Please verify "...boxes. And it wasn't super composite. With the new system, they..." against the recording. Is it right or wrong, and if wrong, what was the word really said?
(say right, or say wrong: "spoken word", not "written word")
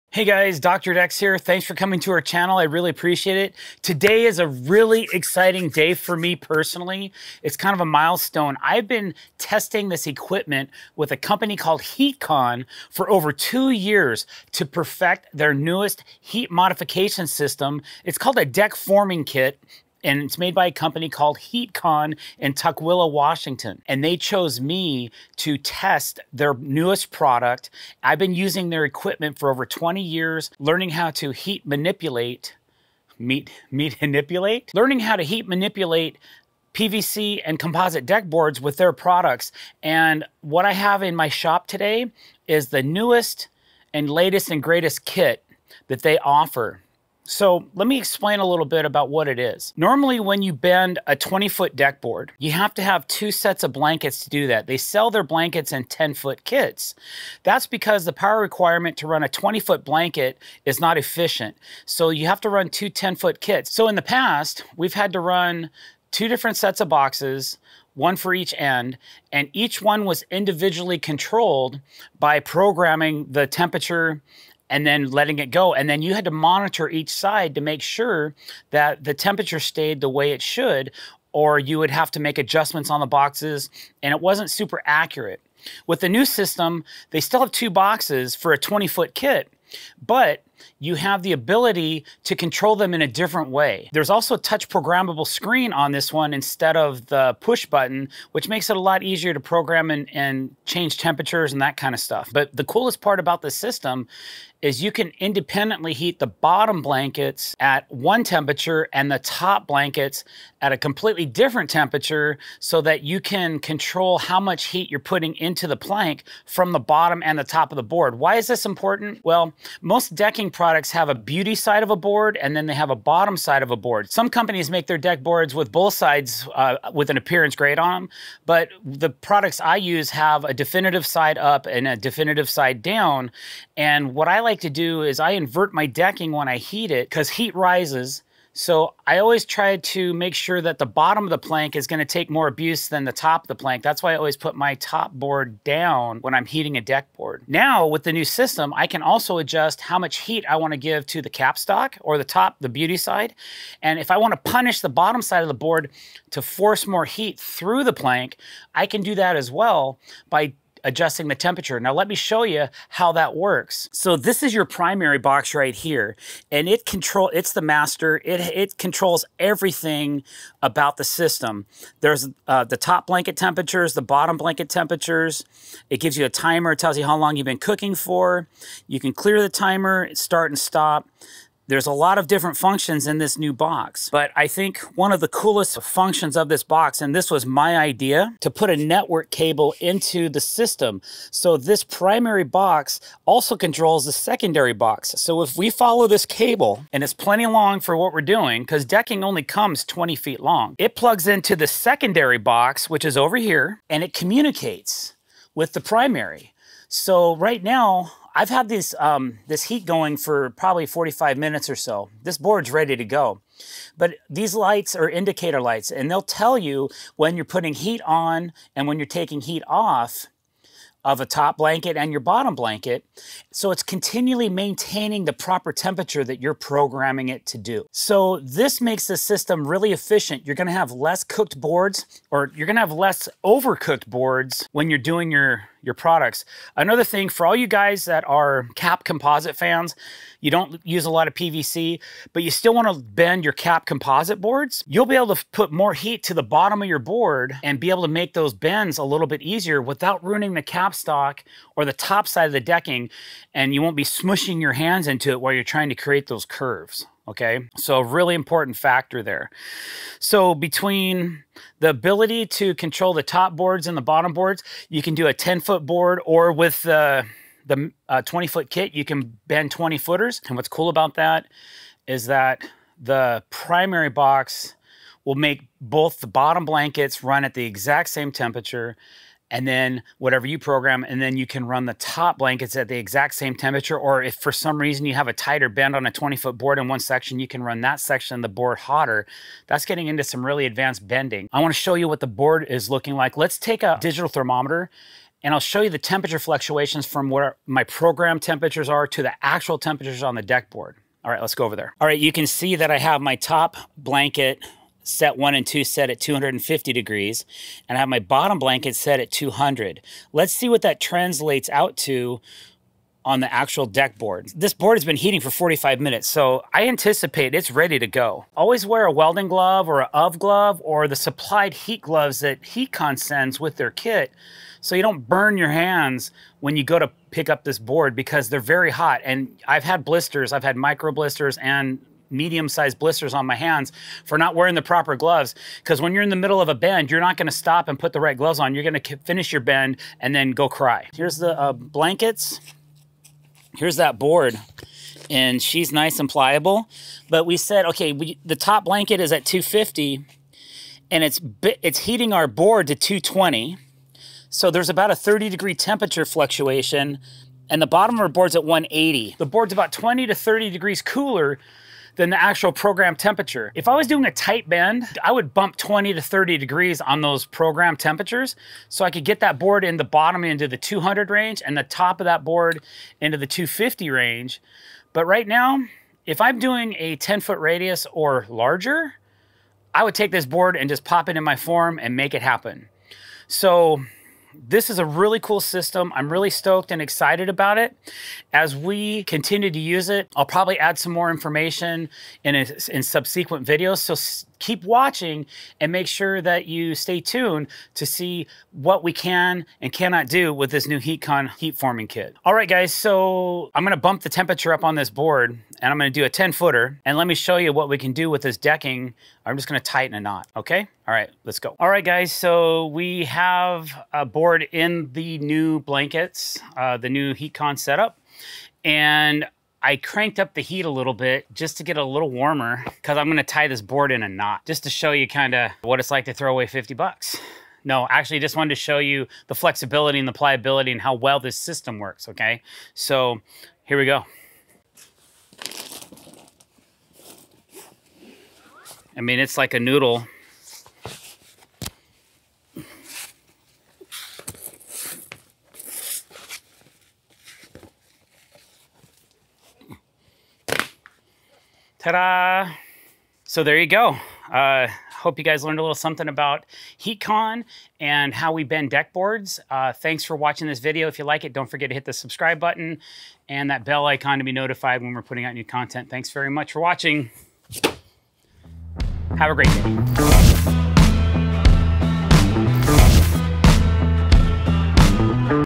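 wrong: "accurate", not "composite".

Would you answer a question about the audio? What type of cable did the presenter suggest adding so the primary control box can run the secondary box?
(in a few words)
network cable.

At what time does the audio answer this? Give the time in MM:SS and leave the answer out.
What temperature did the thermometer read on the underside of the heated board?
05:58.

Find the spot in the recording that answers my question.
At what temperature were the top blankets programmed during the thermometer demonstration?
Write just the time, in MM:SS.
05:06.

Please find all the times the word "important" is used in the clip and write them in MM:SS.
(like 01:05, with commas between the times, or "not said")
01:58, 04:18.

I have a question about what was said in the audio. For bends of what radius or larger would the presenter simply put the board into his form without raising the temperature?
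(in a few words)
10 foot radius.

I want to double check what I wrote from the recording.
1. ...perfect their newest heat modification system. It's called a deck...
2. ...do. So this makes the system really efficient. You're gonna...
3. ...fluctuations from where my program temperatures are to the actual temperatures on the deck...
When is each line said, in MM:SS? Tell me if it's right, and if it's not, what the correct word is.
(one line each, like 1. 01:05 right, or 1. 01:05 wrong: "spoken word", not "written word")
1. 00:14 right
2. 03:47 right
3. 04:56 right.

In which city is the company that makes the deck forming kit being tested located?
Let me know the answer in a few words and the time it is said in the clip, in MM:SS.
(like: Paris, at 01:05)
Tukwila, Washington, at 00:22.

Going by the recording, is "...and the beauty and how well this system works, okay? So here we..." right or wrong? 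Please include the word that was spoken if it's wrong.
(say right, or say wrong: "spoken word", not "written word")
wrong: "pliability", not "beauty".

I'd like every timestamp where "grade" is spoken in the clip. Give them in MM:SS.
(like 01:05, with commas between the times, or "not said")
02:07.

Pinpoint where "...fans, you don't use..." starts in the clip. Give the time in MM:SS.
03:59.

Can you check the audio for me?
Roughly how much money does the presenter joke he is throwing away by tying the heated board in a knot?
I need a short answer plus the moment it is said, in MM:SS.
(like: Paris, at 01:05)
$50, at 07:06.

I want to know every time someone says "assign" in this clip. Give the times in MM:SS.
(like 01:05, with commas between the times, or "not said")
not said.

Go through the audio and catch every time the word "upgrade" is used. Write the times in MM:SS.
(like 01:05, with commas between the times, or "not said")
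not said.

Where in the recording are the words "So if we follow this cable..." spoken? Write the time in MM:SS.
03:15.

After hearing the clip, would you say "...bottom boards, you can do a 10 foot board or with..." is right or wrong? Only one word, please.
right.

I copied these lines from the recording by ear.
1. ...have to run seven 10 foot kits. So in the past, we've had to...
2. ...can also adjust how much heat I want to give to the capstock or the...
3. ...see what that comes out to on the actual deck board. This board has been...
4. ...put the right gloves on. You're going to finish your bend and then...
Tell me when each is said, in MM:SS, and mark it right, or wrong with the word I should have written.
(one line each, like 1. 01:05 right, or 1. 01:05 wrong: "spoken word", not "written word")
1. 01:02 wrong: "two", not "seven"
2. 02:28 right
3. 05:10 wrong: "translates", not "comes"
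4. 05:37 right.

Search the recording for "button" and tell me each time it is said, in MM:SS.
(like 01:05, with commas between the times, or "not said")
01:37, 07:42.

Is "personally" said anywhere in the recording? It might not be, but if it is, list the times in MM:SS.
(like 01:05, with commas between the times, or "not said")
00:06.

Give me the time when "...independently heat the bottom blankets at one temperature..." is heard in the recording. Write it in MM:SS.
01:45.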